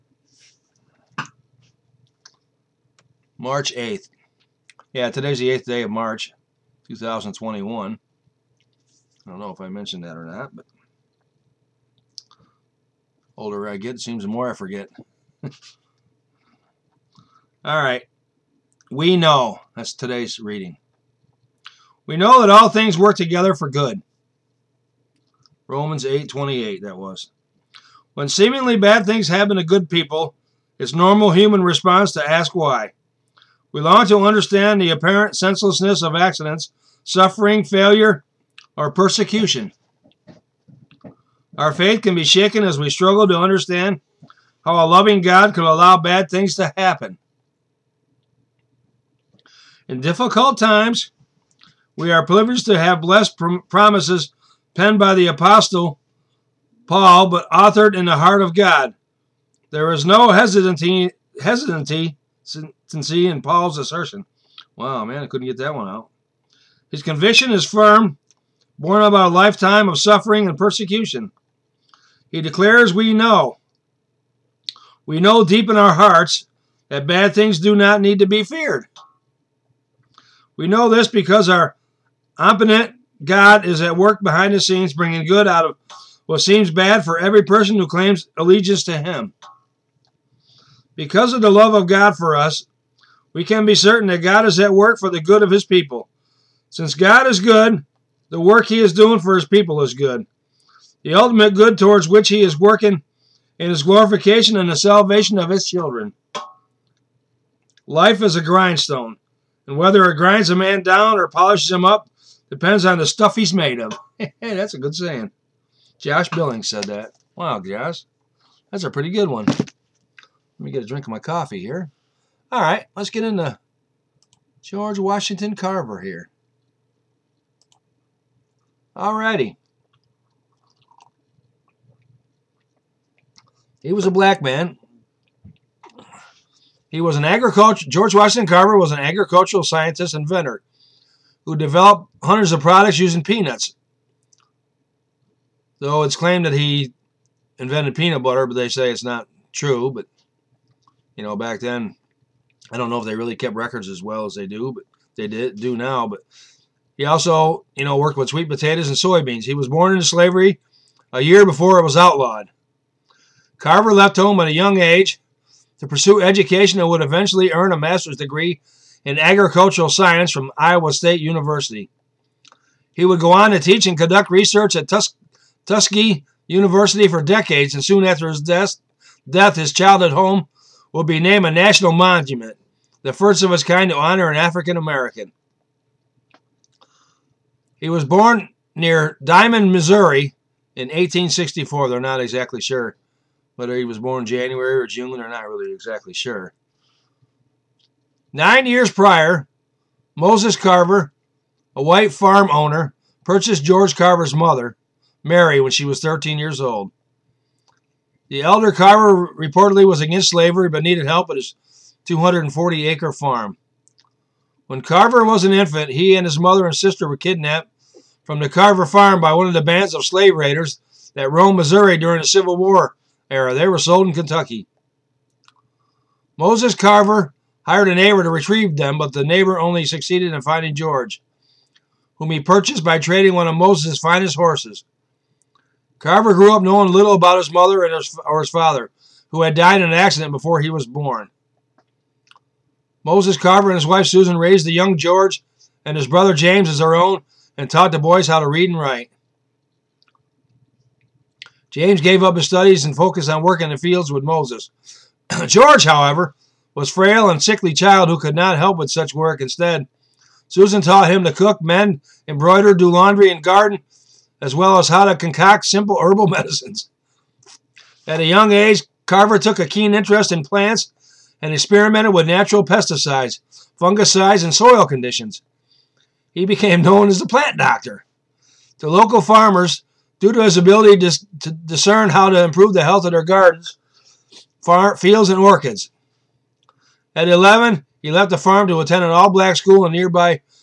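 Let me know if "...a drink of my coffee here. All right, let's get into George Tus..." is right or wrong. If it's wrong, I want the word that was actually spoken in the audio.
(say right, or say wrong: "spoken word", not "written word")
wrong: "Washington", not "Tus".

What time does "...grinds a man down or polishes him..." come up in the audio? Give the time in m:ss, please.
1:50.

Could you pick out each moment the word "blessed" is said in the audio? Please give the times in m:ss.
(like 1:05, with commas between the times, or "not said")
0:53.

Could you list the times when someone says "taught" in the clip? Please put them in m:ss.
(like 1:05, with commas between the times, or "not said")
4:07, 4:20.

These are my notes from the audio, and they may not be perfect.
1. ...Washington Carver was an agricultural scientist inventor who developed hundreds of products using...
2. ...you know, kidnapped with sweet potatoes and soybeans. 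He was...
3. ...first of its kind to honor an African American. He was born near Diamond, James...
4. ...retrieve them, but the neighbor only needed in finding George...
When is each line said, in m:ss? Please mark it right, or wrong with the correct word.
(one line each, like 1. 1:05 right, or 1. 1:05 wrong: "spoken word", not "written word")
1. 2:18 right
2. 2:37 wrong: "worked", not "kidnapped"
3. 3:03 wrong: "Missouri", not "James"
4. 3:48 wrong: "succeeded", not "needed".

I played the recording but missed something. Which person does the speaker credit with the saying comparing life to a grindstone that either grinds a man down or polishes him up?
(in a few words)
Josh Billings.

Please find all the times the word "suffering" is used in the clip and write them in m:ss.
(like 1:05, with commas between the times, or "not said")
0:37, 1:09.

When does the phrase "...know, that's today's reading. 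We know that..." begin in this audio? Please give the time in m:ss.
0:19.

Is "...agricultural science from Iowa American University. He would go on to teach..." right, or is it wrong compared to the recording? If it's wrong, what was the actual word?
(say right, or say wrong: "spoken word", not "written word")
wrong: "State", not "American".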